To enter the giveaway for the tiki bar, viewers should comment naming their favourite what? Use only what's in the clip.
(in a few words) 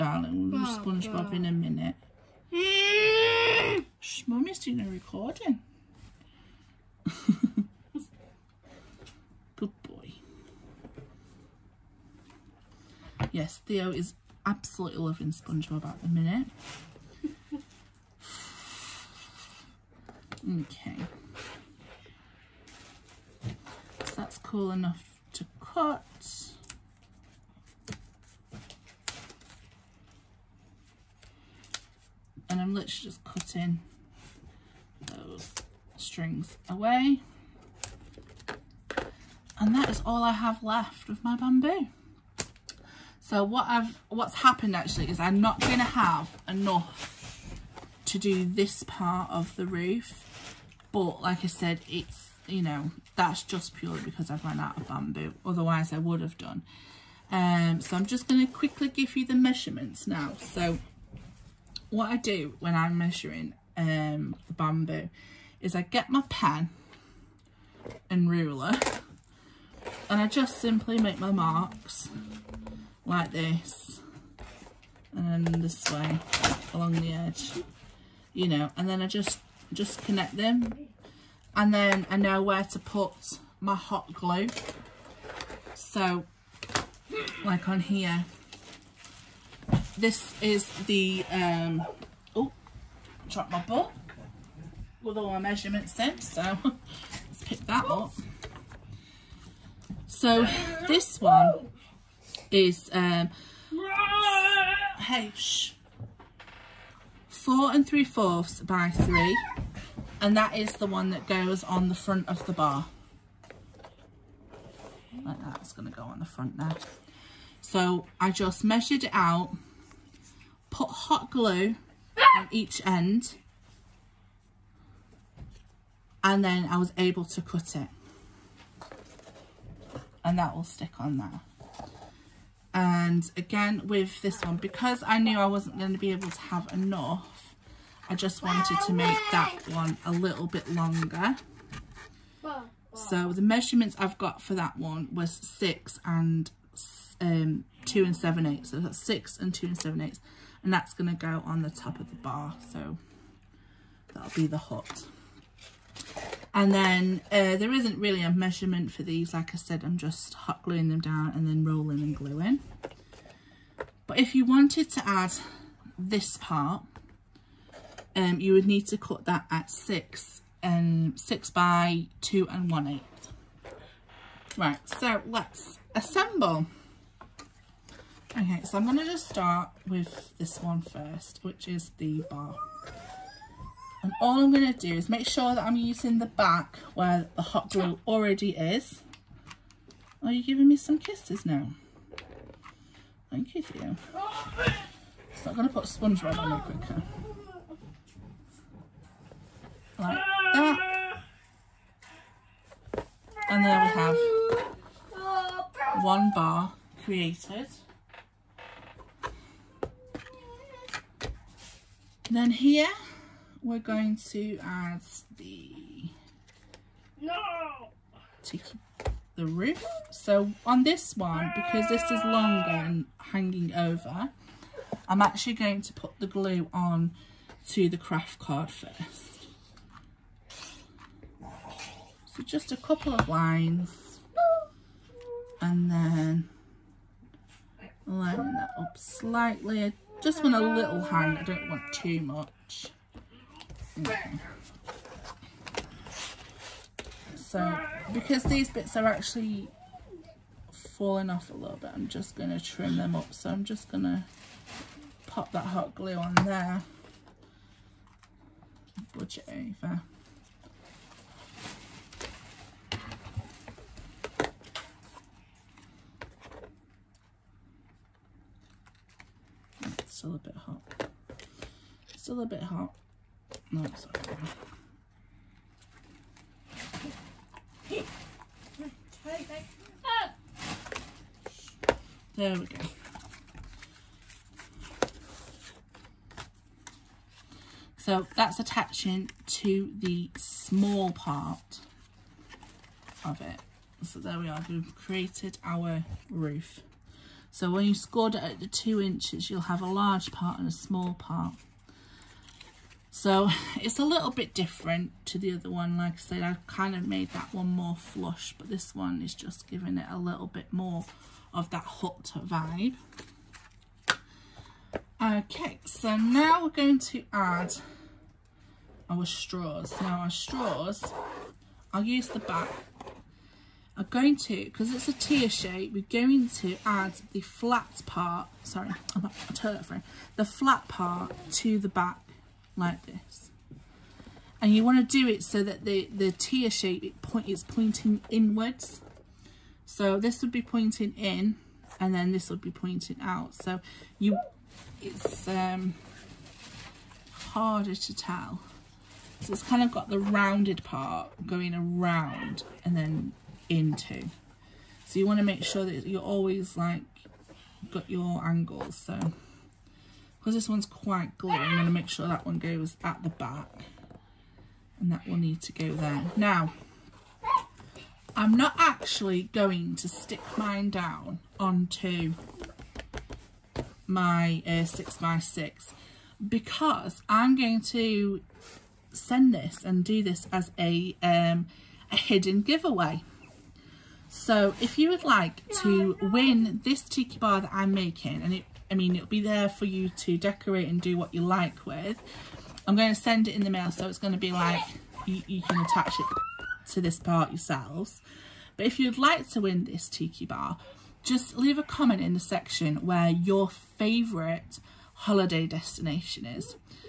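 holiday destination.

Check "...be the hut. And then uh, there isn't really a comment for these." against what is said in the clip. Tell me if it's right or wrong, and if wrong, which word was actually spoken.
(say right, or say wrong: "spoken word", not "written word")
wrong: "measurement", not "comment".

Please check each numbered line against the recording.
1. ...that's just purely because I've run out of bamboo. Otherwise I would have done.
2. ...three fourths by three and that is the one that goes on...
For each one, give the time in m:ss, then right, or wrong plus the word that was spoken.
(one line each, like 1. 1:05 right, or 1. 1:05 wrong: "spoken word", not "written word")
1. 0:53 right
2. 1:47 right.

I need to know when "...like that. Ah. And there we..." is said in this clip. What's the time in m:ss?
3:19.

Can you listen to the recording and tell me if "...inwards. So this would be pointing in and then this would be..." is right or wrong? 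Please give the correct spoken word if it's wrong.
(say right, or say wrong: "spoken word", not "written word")
right.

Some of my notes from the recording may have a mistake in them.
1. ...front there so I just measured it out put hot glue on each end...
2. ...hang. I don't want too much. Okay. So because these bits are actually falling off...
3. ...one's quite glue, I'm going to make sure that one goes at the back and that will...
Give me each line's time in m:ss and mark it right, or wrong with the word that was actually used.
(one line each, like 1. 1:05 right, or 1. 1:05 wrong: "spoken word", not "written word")
1. 1:56 right
2. 4:01 right
3. 6:00 right.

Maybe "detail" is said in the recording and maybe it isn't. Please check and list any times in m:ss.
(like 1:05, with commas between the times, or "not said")
not said.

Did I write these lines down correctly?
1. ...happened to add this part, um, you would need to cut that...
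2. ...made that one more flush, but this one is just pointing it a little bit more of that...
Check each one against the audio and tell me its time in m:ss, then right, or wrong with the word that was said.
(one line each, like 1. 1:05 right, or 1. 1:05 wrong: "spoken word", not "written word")
1. 2:44 wrong: "wanted", not "happened"
2. 5:07 wrong: "giving", not "pointing".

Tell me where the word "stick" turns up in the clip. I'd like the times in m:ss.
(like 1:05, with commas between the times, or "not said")
2:10, 6:10.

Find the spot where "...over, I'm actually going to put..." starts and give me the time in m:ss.
3:43.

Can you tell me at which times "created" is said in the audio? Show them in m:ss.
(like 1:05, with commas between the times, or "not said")
3:27, 4:54.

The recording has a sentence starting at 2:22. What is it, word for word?
So the measurements I've got for that one was six and um, two and seven eighths.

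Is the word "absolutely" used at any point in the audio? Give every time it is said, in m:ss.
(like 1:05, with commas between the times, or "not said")
0:14.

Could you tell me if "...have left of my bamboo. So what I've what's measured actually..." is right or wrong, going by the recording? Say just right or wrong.
wrong.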